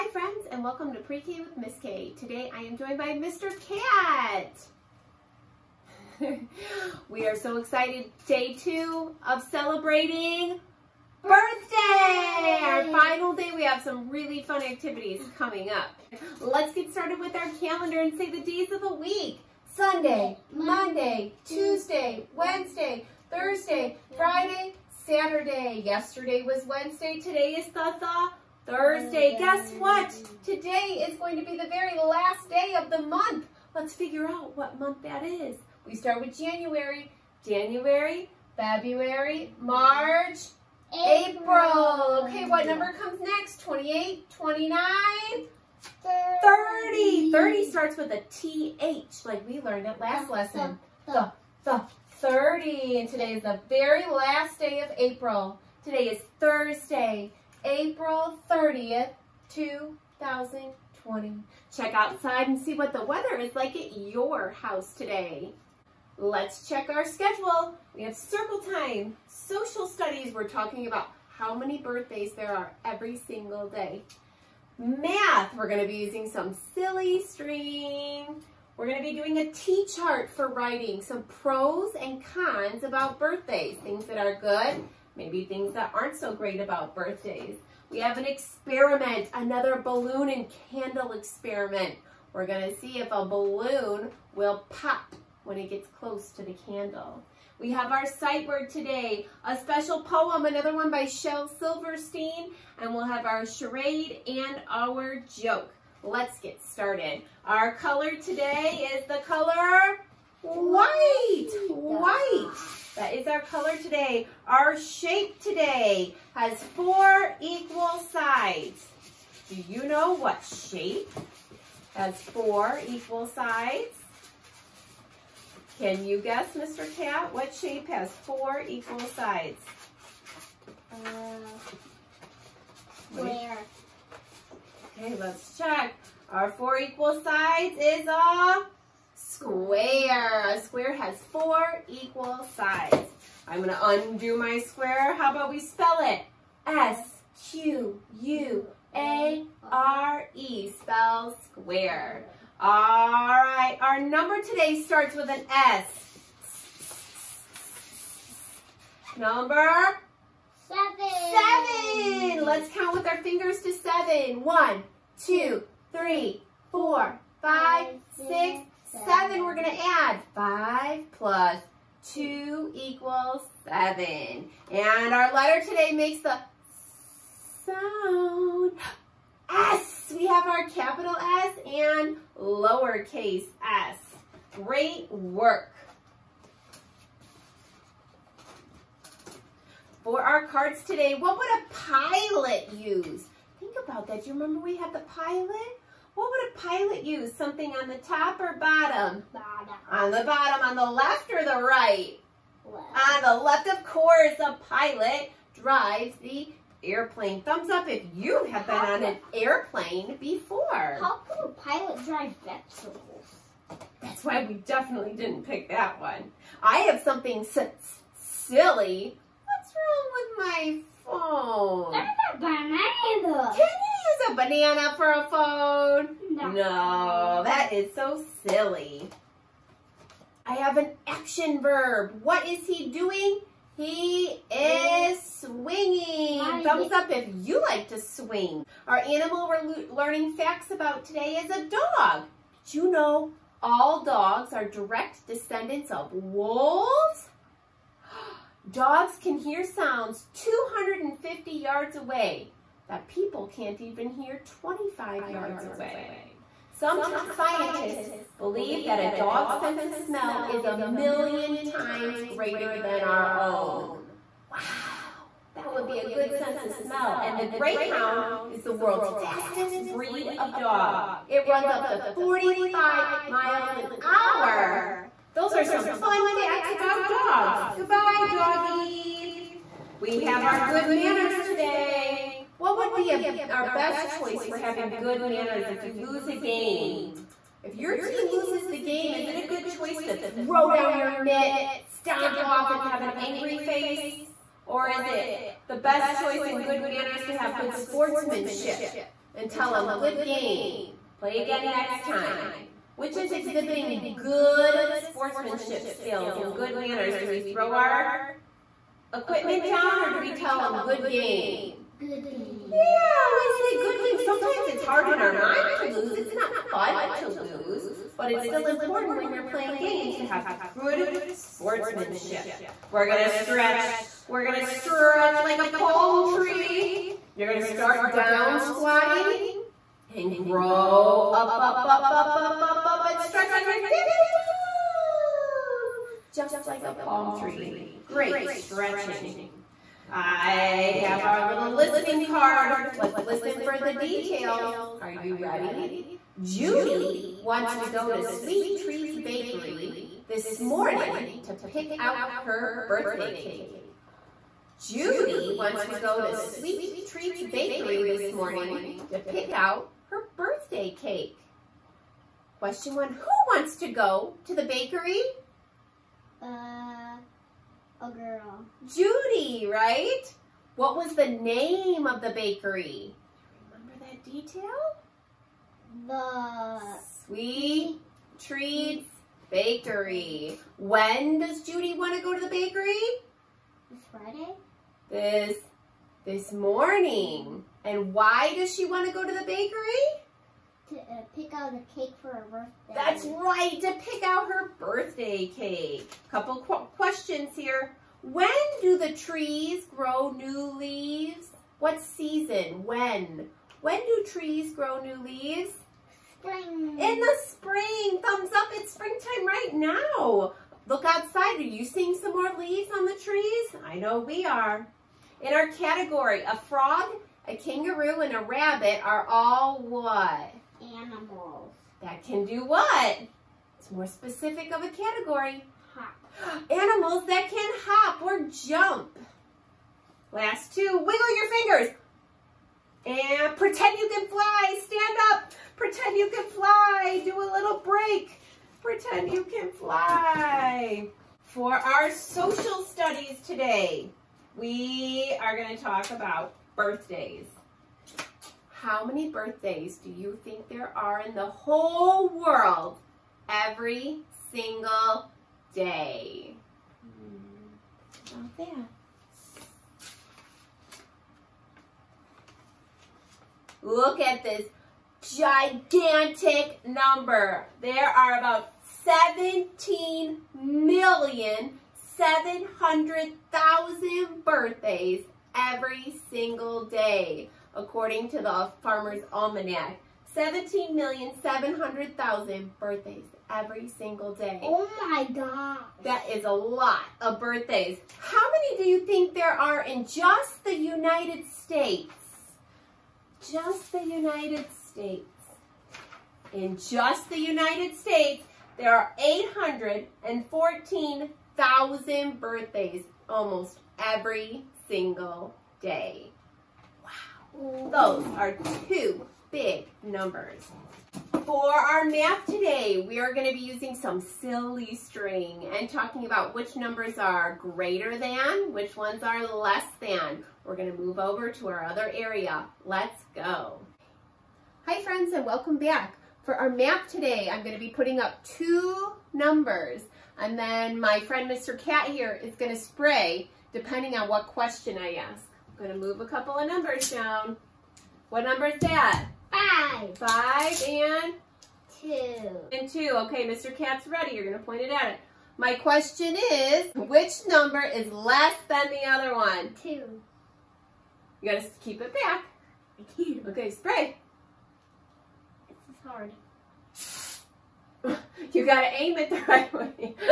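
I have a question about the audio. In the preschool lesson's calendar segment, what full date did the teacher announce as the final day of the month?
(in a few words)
April 30th, 2020.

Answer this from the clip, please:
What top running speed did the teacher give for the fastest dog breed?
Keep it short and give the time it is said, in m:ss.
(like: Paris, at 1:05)
45 miles an hour, at 4:32.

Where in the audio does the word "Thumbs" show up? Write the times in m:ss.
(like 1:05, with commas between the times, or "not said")
3:27, 3:56, 6:48.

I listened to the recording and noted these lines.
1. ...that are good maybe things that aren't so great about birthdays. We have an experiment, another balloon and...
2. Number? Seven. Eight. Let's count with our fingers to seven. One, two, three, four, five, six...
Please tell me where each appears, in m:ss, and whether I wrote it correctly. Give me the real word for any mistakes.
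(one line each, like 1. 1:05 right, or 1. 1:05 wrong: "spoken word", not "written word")
1. 1:24 right
2. 2:39 wrong: "Seven", not "Eight".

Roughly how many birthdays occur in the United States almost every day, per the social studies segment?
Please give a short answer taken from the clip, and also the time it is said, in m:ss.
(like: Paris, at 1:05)
814,000, at 8:19.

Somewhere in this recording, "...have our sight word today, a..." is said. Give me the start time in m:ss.
1:37.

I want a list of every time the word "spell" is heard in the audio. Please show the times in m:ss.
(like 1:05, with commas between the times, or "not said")
2:25, 2:30.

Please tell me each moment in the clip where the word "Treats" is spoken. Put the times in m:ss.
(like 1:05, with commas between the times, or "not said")
5:48, 5:57, 6:18.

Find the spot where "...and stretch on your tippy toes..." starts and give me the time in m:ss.
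5:33.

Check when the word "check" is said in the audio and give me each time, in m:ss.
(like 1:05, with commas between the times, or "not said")
1:01, 1:06, 2:15.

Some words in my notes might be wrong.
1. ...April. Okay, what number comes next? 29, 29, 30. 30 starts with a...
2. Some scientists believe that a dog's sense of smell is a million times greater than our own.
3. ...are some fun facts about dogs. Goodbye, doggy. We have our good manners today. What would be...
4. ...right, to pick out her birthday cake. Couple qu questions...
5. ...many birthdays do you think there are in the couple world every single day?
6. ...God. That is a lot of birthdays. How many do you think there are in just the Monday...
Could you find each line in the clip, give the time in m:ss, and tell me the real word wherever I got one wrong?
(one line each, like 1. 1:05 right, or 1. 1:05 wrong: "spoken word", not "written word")
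1. 0:40 wrong: "28", not "29"
2. 4:16 right
3. 4:35 right
4. 6:33 right
5. 7:29 wrong: "whole", not "couple"
6. 8:05 wrong: "United", not "Monday".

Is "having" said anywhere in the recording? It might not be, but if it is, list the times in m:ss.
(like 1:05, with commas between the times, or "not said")
4:44.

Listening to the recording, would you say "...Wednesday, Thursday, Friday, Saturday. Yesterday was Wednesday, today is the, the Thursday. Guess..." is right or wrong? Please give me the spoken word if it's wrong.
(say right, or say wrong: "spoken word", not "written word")
right.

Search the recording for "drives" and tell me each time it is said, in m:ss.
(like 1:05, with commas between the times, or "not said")
3:25, 3:32.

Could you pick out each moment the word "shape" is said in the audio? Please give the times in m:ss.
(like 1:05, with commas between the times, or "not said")
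1:54, 2:00, 2:07.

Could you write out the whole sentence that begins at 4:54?
Or is it the best choice and good manners to have good sportsmanship and tell them, good game, play again next time?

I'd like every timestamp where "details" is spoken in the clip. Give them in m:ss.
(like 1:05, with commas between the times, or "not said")
5:43, 6:14.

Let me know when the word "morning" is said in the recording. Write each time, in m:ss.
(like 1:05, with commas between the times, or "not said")
5:50, 5:58, 6:26.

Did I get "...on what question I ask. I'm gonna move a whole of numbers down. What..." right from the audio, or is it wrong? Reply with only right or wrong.
wrong.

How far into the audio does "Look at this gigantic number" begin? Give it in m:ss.
7:43.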